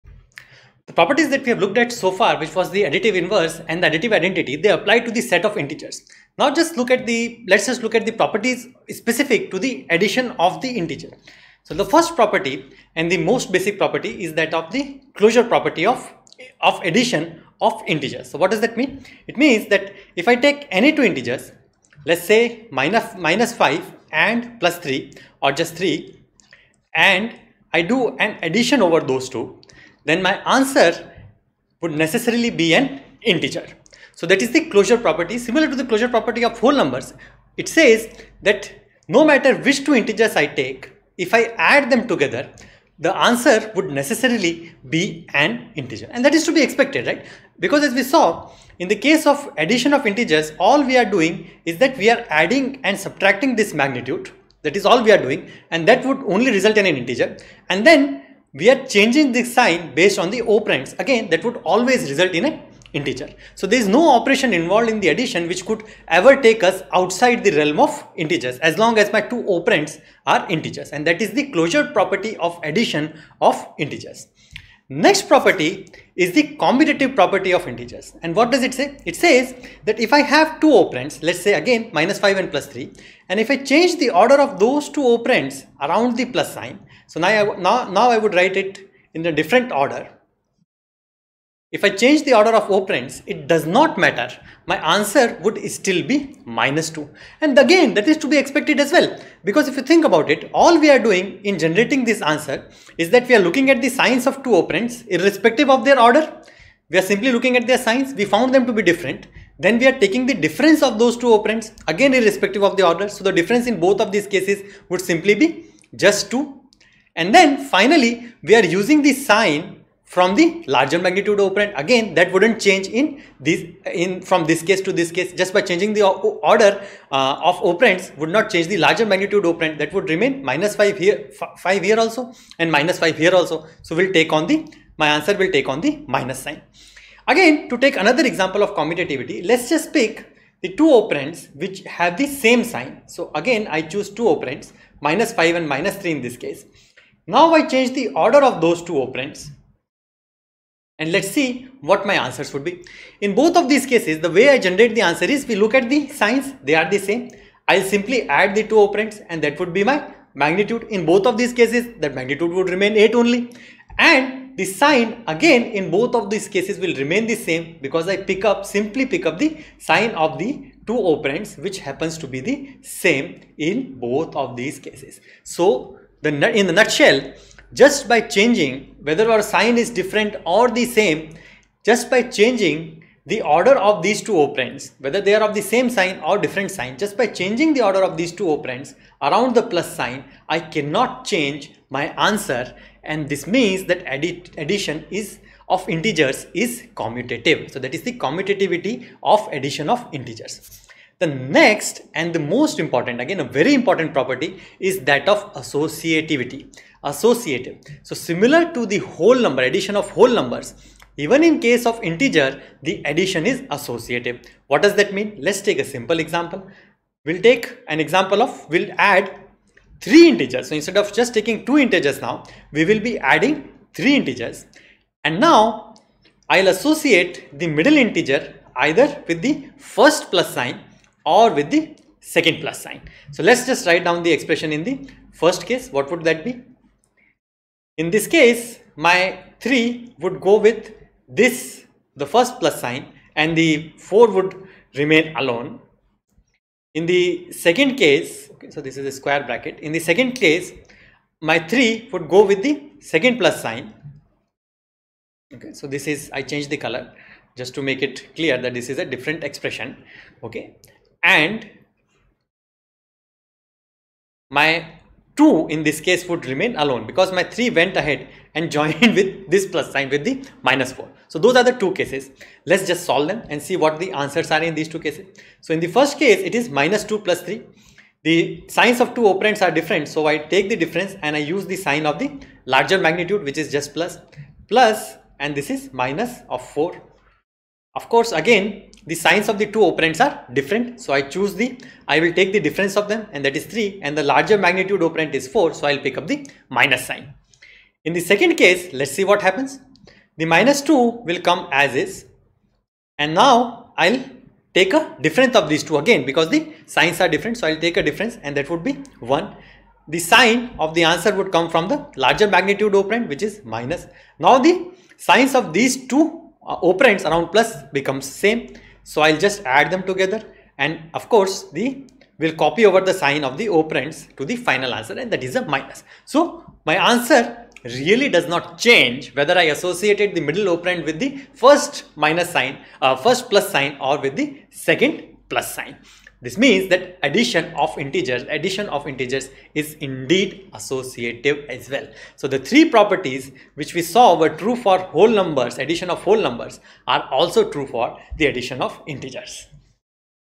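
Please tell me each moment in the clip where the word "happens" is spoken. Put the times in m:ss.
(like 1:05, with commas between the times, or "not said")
2:51, 4:59.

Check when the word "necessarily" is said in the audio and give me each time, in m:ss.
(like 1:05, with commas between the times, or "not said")
0:31, 0:43.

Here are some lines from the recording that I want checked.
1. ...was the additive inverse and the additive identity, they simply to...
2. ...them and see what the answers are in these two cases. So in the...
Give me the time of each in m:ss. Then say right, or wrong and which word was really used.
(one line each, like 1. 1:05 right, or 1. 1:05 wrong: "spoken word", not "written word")
1. 0:02 wrong: "apply", not "simply"
2. 4:33 right.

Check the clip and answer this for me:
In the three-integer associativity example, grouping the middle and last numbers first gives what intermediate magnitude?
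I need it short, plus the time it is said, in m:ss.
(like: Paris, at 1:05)
1, at 5:09.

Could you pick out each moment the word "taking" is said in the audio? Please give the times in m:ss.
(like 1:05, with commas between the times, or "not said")
1:49, 3:41.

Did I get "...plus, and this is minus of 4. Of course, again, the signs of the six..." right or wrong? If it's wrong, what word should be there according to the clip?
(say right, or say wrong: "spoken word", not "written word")
wrong: "two", not "six".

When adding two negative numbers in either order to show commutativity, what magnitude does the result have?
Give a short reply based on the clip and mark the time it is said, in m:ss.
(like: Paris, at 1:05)
8, at 2:42.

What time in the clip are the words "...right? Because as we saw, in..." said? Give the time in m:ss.
0:47.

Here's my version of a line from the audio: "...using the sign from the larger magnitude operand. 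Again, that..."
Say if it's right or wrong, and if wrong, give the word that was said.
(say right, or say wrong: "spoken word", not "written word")
right.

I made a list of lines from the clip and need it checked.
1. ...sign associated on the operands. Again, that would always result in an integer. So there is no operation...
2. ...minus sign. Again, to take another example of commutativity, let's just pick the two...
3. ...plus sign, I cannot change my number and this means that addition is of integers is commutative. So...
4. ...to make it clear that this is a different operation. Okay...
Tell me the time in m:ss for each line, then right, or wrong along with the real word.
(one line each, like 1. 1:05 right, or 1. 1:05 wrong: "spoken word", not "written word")
1. 0:59 wrong: "based", not "associated"
2. 2:16 right
3. 3:09 wrong: "answer", not "number"
4. 4:17 wrong: "expression", not "operation".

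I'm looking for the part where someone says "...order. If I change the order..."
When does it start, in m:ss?
1:29.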